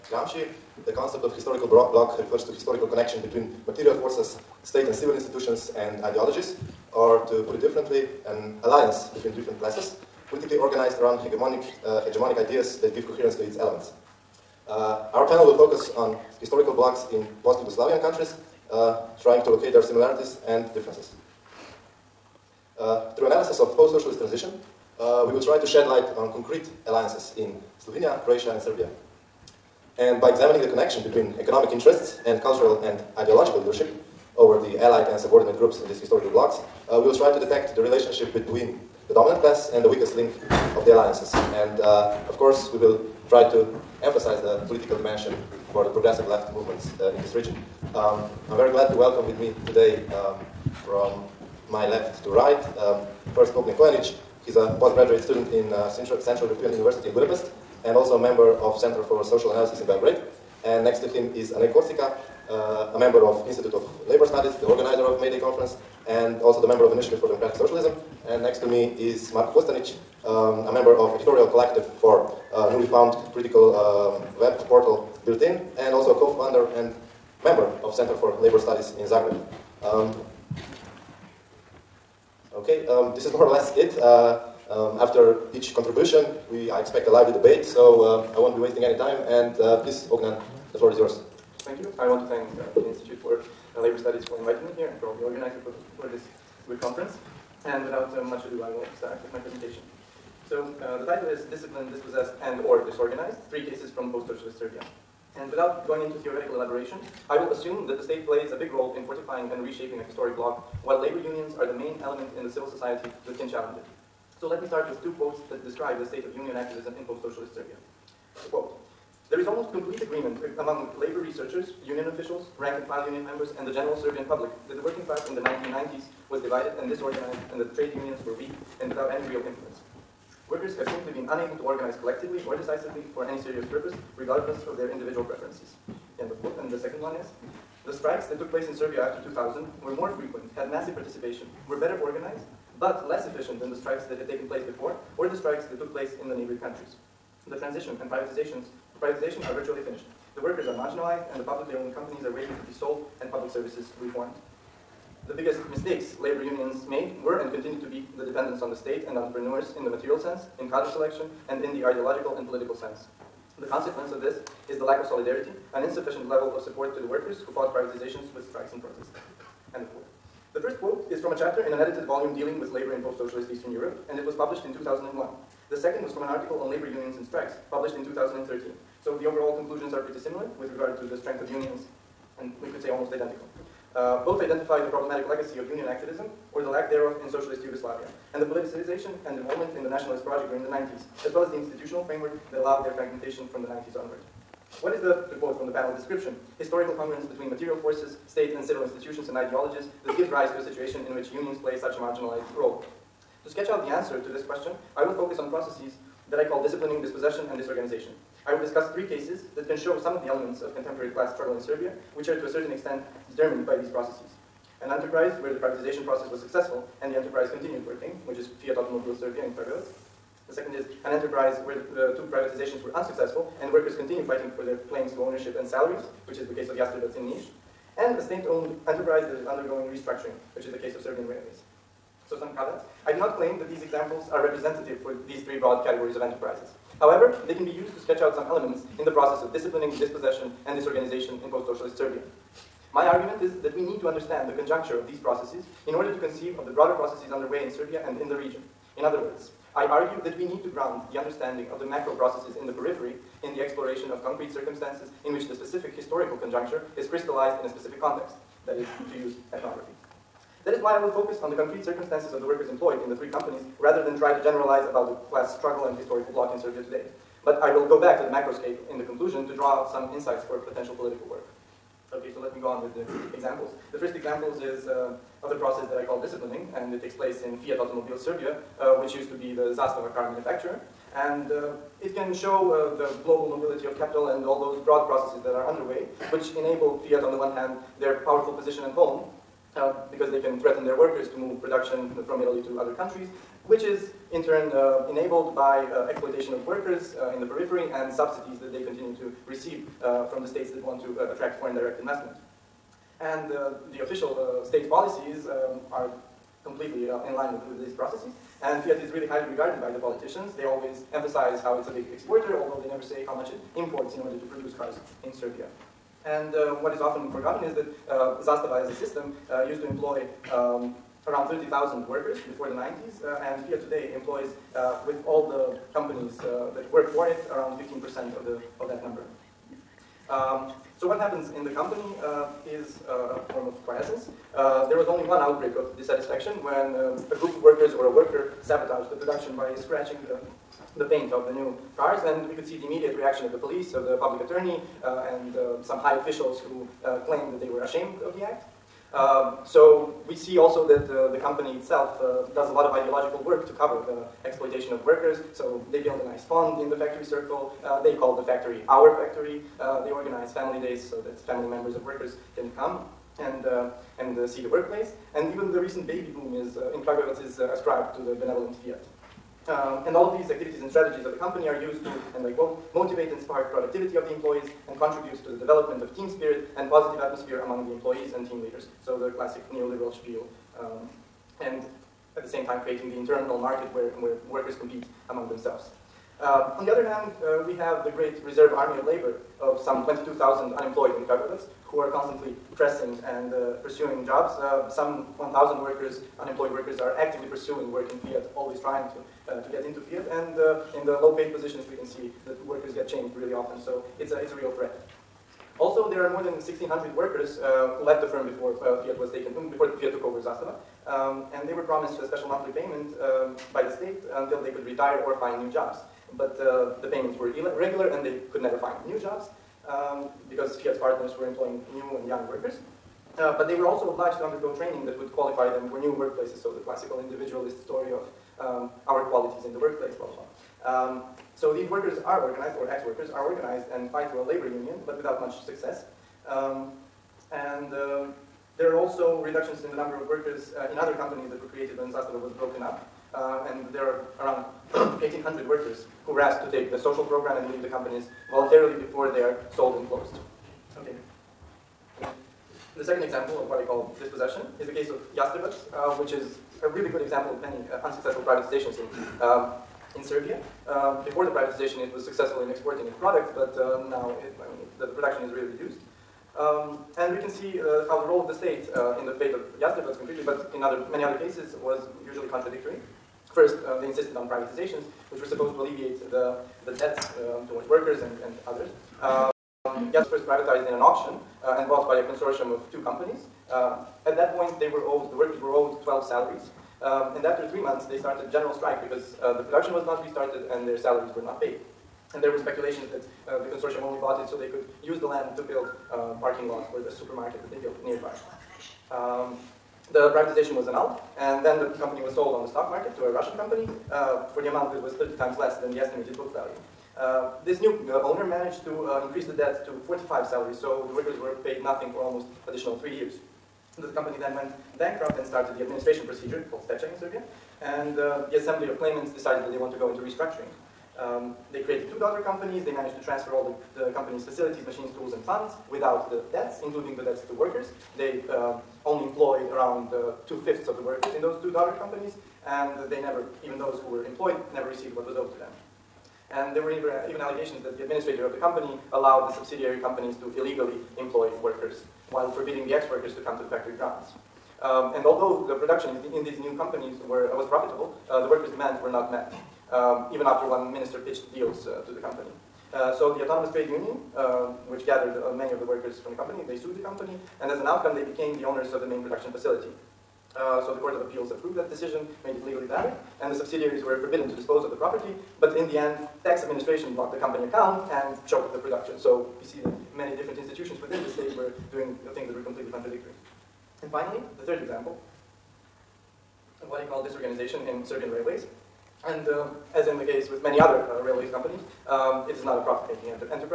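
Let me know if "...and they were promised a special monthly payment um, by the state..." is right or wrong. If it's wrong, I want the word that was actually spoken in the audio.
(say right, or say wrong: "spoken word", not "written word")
right.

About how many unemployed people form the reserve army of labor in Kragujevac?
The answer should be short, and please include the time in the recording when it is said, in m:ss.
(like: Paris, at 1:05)
22,000, at 6:30.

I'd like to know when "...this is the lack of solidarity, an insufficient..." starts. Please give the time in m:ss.
2:44.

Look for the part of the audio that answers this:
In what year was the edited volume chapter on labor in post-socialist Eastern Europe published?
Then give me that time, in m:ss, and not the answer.
2:54.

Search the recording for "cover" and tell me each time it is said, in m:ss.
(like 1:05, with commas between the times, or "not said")
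5:53.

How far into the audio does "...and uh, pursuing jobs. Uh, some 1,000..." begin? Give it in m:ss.
6:33.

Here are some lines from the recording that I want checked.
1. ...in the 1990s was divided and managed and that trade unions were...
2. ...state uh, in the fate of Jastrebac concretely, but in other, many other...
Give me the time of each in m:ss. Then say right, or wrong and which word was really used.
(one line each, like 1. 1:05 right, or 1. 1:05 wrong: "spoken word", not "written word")
1. 2:05 wrong: "disorganized", not "managed"
2. 7:48 right.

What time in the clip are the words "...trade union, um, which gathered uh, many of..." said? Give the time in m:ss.
9:13.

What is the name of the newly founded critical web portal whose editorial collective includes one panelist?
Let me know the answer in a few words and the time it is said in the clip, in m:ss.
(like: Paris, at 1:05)
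Bilten, at 1:15.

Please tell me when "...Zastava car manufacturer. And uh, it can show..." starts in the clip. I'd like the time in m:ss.
4:39.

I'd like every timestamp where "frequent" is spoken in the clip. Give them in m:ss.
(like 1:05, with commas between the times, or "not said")
2:20.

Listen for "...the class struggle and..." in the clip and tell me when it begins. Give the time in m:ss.
4:25.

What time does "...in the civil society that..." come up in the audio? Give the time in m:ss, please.
1:52.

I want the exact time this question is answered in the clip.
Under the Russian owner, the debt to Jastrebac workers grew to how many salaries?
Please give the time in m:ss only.
8:30.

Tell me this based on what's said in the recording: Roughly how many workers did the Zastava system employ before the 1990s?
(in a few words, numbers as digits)
30,000.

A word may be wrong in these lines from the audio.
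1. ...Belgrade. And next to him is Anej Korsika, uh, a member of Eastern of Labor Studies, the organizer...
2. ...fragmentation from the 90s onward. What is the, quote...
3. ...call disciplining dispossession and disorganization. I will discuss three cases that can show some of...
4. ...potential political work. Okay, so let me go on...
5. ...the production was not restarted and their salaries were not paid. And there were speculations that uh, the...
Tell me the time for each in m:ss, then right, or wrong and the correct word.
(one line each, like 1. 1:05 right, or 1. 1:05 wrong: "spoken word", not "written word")
1. 0:59 wrong: "Institute", not "Eastern"
2. 3:12 right
3. 3:26 right
4. 4:30 right
5. 8:09 right.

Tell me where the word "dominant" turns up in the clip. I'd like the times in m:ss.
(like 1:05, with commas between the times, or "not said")
0:39.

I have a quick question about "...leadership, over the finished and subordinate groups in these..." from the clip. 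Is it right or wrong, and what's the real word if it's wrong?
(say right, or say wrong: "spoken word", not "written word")
wrong: "allied", not "finished".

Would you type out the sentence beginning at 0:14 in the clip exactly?
Uh, our panel will focus on historical blocs in post-Yugoslavian countries, uh, trying to locate their similarities and differences.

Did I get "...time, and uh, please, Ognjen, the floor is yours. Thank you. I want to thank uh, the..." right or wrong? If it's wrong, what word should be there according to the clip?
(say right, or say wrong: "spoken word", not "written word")
right.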